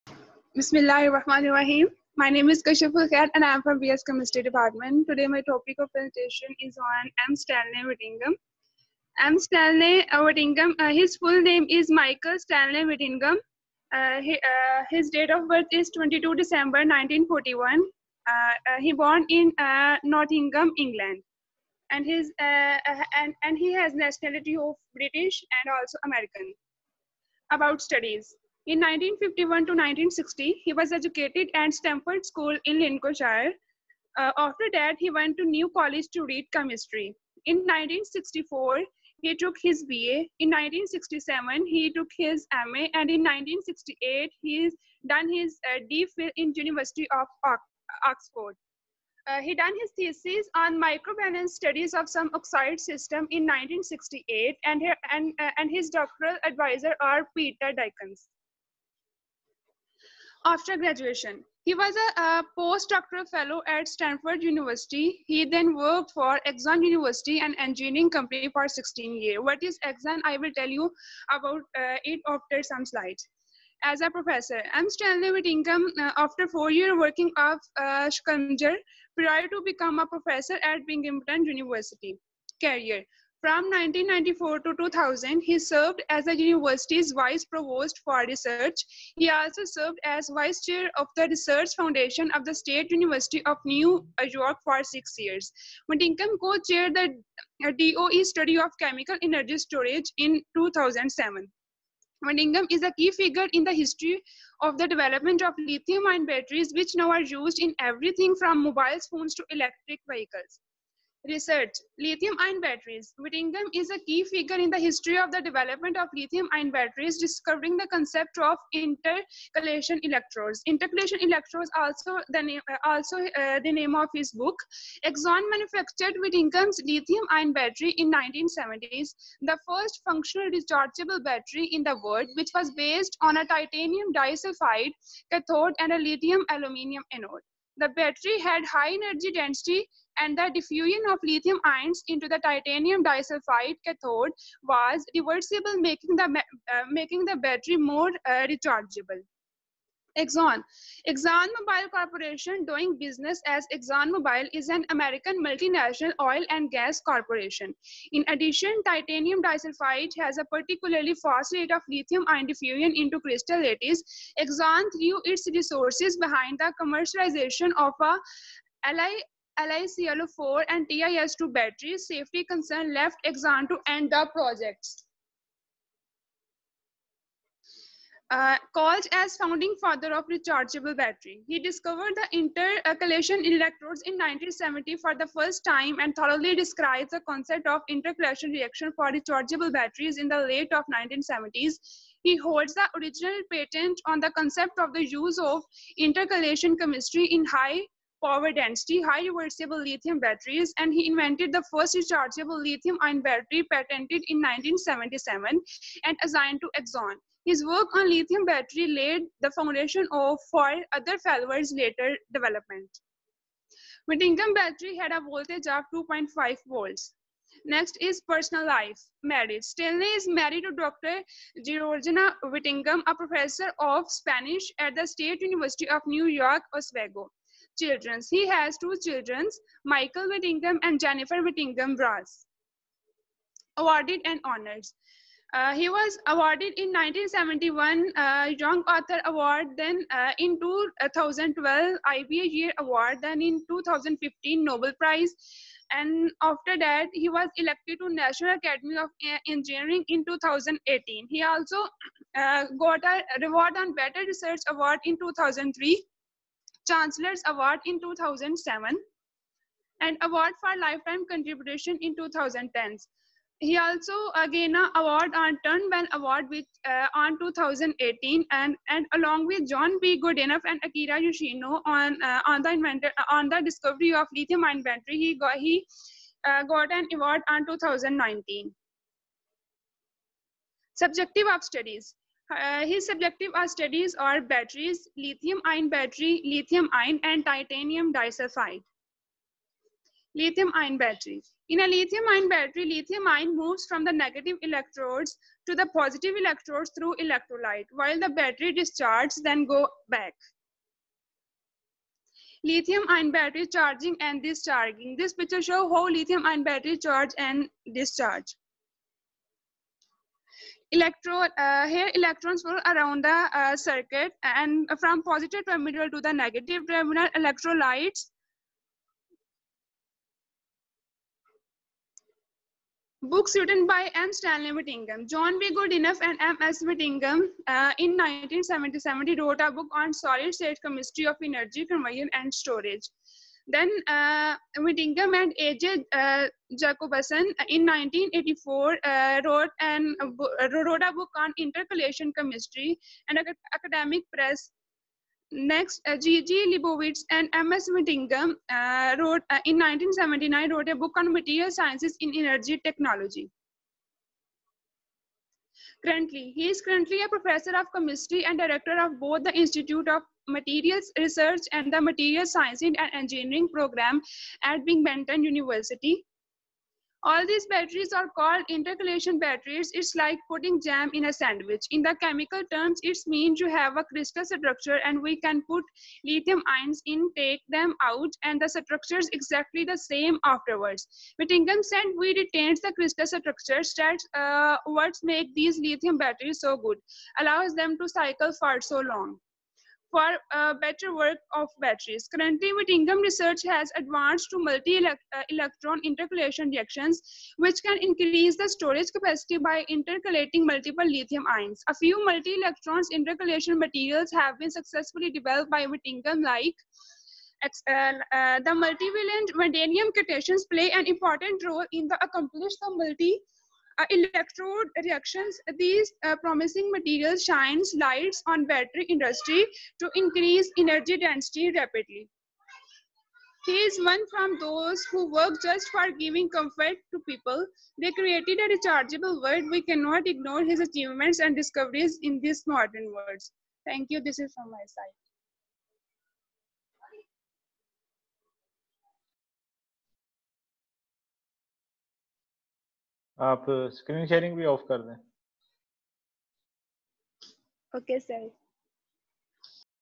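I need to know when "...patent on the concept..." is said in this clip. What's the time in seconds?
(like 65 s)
193 s.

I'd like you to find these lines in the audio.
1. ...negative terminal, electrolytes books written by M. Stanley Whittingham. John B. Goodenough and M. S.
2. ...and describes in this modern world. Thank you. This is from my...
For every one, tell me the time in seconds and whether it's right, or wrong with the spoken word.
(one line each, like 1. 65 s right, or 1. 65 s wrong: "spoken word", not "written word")
1. 316 s right
2. 431 s wrong: "discoveries", not "describes".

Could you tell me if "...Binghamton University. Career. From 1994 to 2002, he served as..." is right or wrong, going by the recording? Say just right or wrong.
wrong.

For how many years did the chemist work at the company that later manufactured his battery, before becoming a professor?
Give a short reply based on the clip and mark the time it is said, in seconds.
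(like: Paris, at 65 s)
16 years, at 68 s.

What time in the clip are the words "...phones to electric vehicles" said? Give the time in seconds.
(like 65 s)
109 s.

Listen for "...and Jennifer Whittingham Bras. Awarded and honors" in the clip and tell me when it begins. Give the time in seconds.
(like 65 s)
230 s.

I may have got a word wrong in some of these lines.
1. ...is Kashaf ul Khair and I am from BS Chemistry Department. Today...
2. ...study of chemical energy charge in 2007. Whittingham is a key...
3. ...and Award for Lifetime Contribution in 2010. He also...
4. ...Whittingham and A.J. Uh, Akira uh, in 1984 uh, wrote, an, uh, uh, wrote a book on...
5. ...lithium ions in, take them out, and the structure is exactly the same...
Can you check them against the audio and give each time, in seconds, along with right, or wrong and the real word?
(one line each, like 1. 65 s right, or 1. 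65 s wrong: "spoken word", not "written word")
1. 2 s right
2. 98 s wrong: "storage", not "charge"
3. 260 s right
4. 334 s wrong: "Jacobson", not "Akira"
5. 376 s right.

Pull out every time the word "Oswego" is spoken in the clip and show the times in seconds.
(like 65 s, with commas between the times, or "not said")
226 s.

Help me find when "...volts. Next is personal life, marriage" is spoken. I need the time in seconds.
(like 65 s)
216 s.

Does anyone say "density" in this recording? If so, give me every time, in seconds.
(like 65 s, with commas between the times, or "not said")
139 s, 198 s, 421 s.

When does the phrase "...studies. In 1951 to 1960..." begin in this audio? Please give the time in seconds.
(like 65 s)
27 s.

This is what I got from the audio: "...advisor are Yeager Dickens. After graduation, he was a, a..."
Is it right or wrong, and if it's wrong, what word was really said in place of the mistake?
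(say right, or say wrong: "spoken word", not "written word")
wrong: "Peter", not "Yeager".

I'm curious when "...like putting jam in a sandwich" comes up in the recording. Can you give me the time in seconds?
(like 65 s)
370 s.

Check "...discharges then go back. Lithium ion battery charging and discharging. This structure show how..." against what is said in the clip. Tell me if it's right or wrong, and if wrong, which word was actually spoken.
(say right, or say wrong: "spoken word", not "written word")
wrong: "picture", not "structure".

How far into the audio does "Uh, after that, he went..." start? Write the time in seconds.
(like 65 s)
34 s.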